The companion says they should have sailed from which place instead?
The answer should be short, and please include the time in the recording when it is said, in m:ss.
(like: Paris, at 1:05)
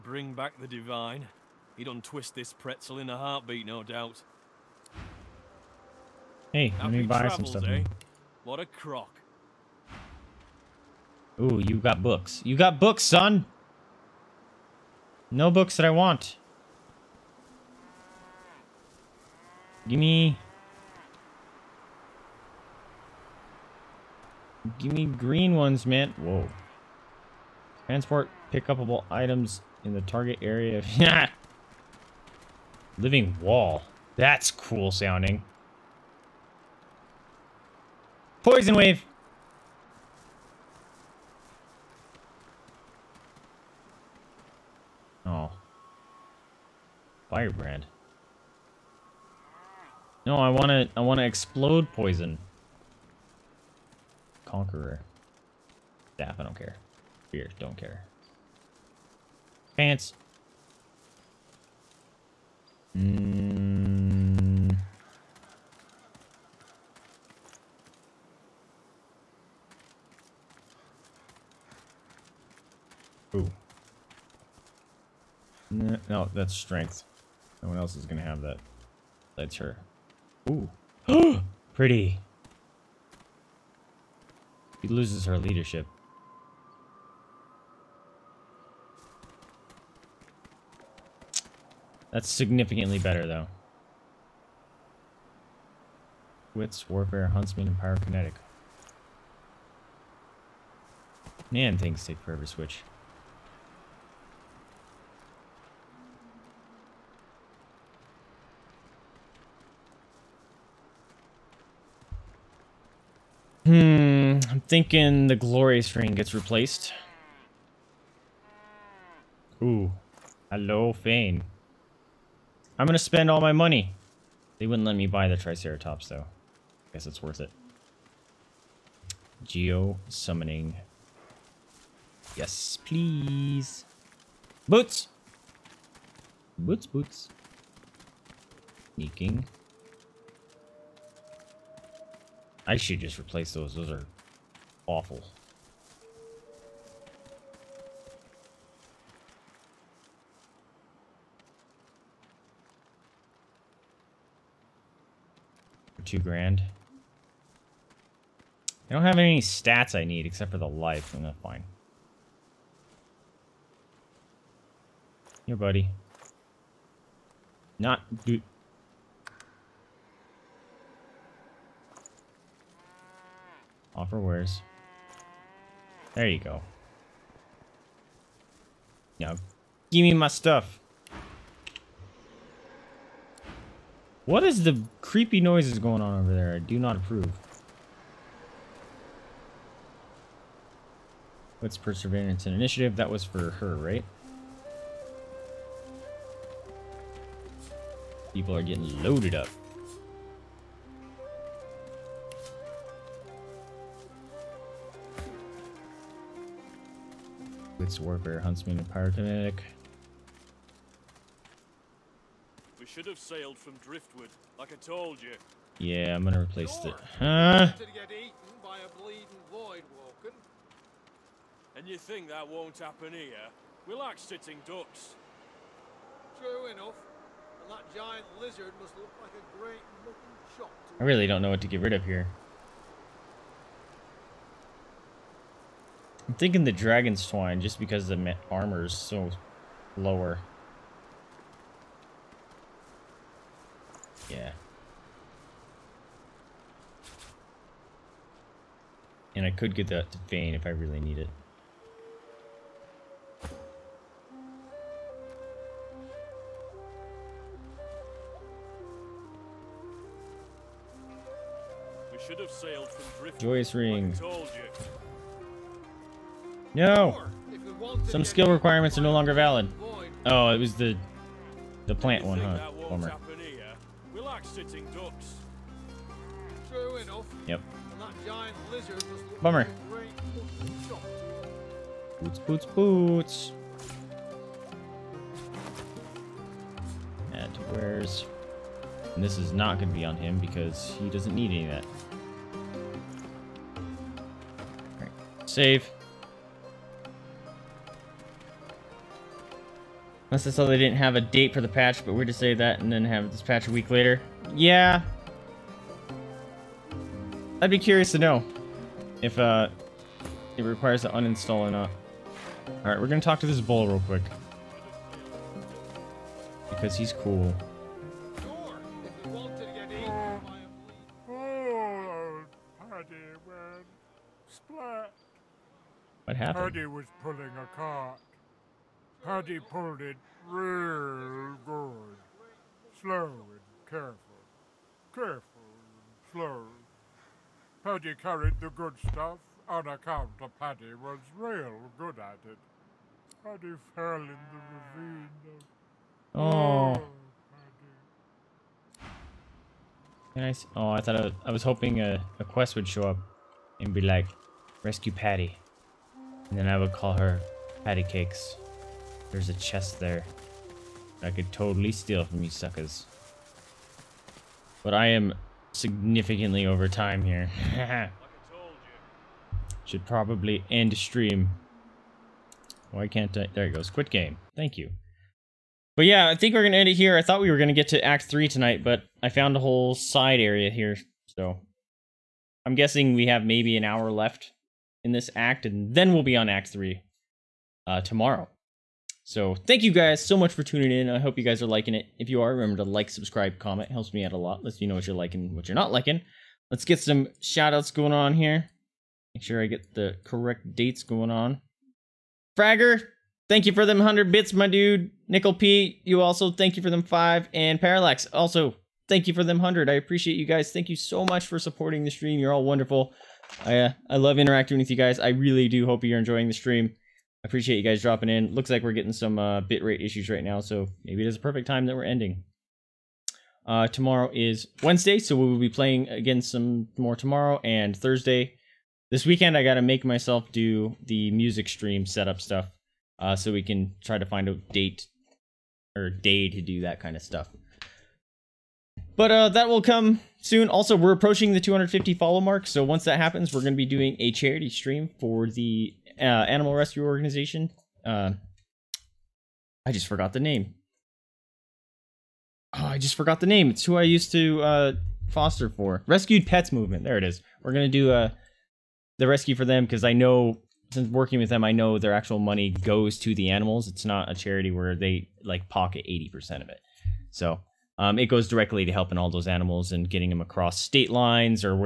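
Driftwood, at 3:33.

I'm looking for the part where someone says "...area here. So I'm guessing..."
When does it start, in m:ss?
6:20.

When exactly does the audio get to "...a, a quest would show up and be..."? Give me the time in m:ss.
5:51.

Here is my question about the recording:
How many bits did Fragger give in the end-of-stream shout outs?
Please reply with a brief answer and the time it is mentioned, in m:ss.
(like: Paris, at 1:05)
100, at 6:43.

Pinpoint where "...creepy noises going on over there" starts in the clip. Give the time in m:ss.
3:04.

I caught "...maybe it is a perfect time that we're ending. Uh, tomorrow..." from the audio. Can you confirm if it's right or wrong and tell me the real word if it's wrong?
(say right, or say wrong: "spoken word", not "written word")
right.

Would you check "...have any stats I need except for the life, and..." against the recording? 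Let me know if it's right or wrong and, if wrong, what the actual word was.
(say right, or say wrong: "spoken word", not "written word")
right.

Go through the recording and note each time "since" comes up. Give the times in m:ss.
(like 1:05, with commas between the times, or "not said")
7:40.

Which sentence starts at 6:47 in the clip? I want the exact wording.
And Parallax, also thank you for them 100.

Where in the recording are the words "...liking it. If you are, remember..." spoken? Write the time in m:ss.
6:31.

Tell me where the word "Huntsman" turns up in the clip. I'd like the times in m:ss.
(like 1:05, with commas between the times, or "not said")
1:37, 3:28.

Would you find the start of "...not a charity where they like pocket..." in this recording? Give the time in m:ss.
7:44.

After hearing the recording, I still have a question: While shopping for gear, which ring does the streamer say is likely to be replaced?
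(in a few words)
Glorious ring.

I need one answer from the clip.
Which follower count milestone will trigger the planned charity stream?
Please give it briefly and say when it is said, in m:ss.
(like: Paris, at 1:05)
250, at 7:21.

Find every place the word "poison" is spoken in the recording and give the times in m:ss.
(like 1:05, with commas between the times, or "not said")
0:38, 0:51.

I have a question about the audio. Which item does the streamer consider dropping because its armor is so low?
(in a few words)
Dragon's Twine.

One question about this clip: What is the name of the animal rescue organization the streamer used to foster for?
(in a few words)
Rescued Pets Movement.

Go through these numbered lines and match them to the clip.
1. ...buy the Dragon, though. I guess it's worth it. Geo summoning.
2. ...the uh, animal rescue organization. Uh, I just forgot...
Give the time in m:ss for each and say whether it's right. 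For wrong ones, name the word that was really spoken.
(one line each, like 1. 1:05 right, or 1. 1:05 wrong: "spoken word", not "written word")
1. 2:05 wrong: "Triceratops", not "Dragon"
2. 7:25 right.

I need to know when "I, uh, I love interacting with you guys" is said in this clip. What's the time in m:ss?
6:53.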